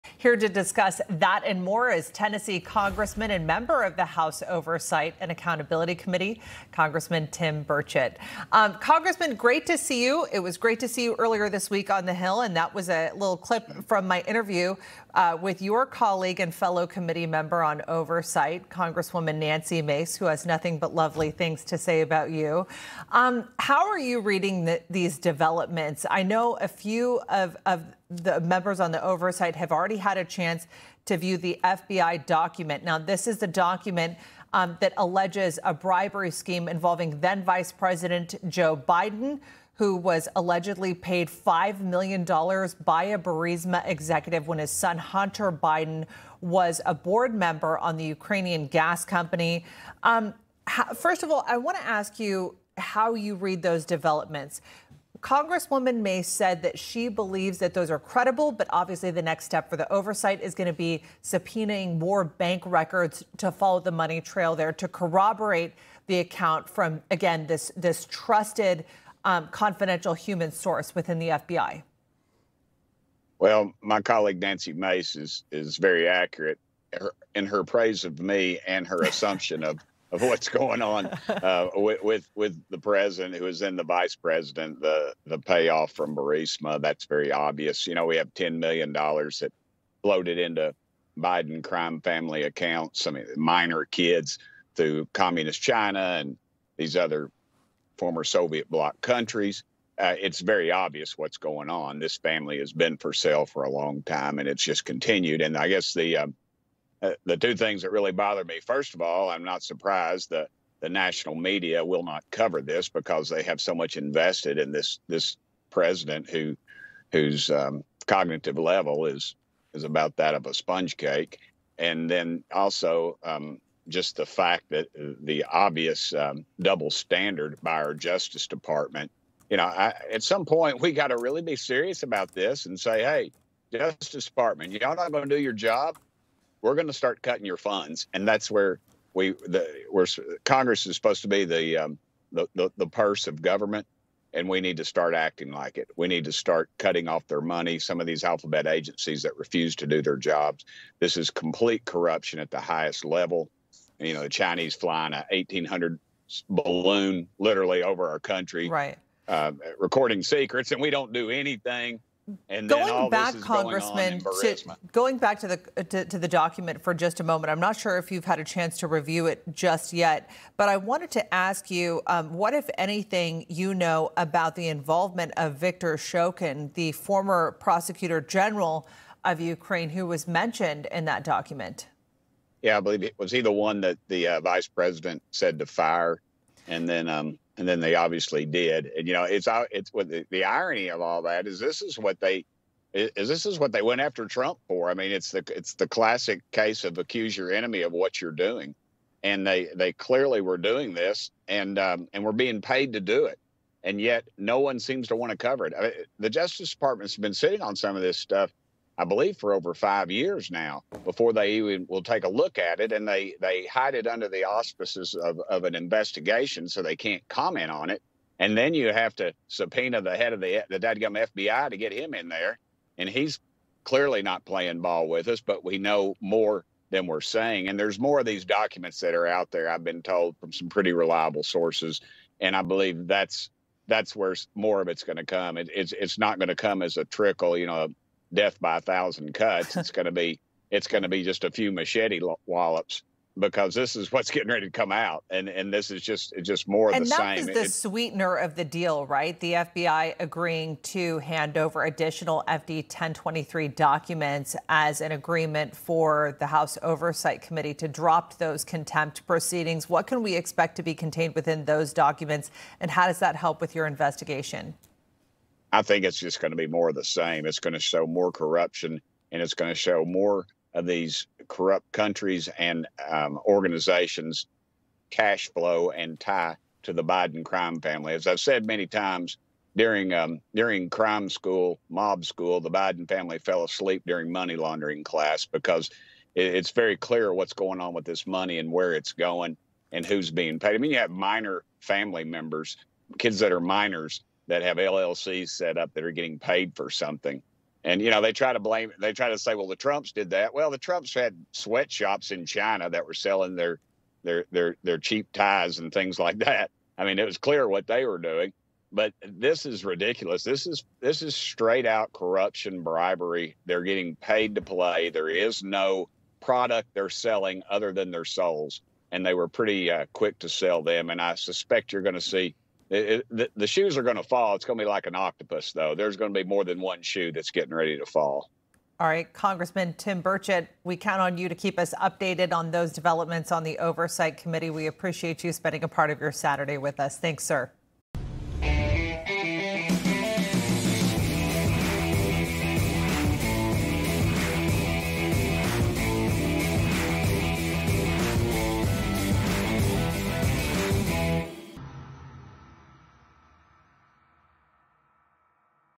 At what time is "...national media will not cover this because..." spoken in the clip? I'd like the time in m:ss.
1:50.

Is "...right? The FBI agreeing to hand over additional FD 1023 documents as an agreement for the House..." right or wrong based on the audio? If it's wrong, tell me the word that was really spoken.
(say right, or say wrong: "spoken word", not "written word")
right.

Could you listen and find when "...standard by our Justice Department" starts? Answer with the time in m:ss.
2:06.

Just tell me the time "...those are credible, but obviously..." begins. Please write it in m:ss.
0:57.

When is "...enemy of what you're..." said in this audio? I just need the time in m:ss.
3:17.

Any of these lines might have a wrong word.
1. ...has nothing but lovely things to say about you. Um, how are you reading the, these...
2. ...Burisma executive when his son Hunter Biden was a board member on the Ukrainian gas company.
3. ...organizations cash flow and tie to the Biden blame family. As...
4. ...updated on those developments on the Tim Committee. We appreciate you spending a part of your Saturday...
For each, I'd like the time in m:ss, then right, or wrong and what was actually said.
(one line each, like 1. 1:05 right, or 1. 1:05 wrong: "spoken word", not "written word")
1. 0:20 right
2. 0:43 right
3. 4:33 wrong: "crime", not "blame"
4. 5:32 wrong: "Oversight", not "Tim".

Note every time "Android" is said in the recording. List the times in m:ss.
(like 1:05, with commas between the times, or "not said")
not said.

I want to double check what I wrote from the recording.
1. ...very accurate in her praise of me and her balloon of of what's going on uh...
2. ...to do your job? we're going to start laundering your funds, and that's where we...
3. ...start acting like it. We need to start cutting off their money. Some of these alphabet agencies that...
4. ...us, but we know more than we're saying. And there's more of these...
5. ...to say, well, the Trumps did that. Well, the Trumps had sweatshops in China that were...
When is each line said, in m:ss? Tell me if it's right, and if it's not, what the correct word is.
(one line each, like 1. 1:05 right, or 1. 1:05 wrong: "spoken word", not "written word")
1. 1:15 wrong: "assumption", not "balloon"
2. 2:15 wrong: "cutting", not "laundering"
3. 2:24 right
4. 3:45 right
5. 4:59 right.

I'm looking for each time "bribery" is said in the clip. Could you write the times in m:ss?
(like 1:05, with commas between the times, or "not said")
0:35, 5:12.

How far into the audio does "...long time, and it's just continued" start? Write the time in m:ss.
1:43.